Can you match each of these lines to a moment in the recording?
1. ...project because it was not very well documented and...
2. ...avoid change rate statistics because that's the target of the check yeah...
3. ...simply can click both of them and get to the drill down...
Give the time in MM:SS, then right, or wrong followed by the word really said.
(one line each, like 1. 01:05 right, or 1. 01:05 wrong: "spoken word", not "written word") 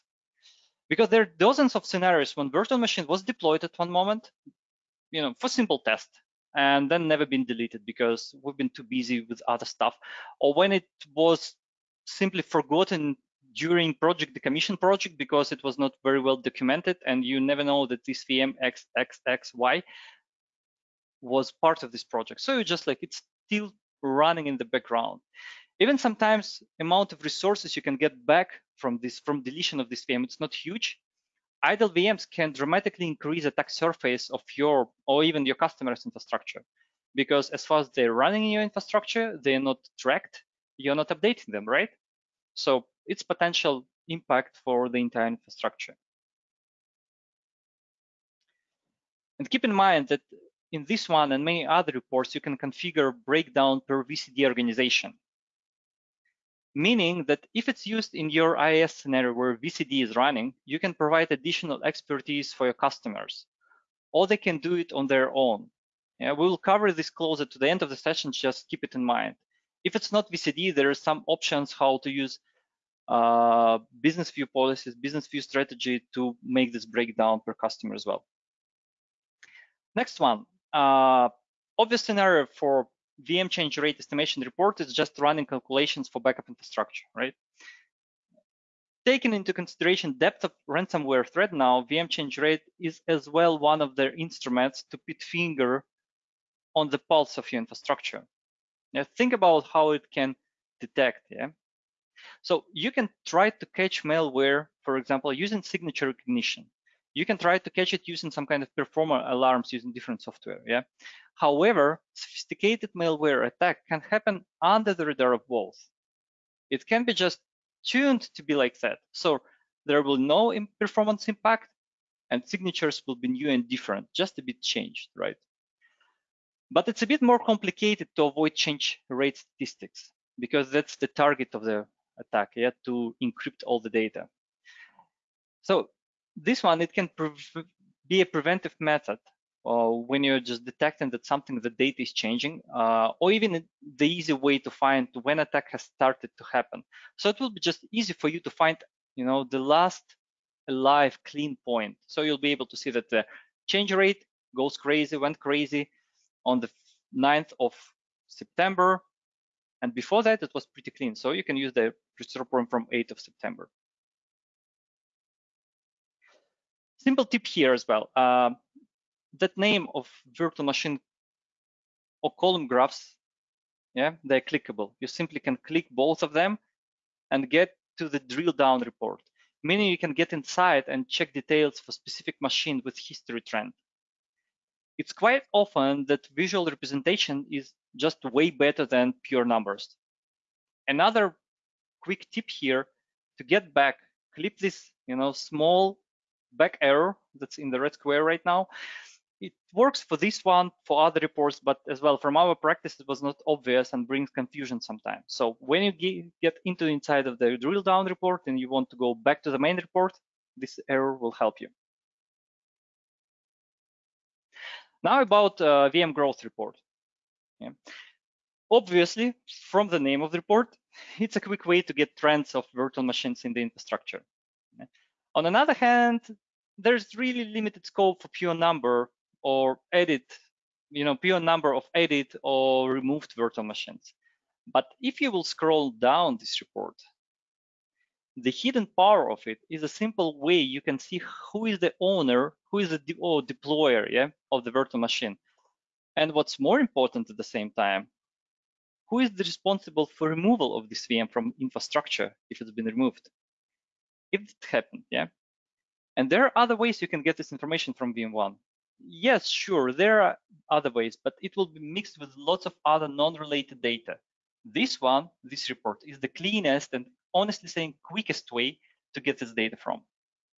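1. 00:14 right
2. 02:08 wrong: "attack", not "check"
3. 02:55 right.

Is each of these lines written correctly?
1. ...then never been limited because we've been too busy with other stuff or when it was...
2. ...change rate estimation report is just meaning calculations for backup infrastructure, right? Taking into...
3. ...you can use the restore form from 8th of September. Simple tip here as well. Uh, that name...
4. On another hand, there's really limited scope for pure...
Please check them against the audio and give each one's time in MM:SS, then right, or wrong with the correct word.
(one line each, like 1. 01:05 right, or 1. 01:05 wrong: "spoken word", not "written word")
1. 00:06 wrong: "deleted", not "limited"
2. 01:23 wrong: "running", not "meaning"
3. 02:41 right
4. 03:45 right.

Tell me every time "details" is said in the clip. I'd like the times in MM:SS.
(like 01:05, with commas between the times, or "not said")
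03:01.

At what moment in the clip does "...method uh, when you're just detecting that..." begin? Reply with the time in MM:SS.
02:18.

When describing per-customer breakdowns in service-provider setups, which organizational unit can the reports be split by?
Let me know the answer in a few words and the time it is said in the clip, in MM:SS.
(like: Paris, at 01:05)
VCD organization, at 00:54.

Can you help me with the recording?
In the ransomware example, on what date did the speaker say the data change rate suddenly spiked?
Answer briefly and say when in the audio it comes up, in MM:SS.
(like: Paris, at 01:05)
9th of September, at 02:37.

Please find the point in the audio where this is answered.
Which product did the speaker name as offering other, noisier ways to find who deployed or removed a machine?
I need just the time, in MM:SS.
04:18.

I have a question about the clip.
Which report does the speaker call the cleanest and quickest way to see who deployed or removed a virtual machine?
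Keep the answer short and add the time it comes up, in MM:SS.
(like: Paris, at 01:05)
VM growth report, at 03:35.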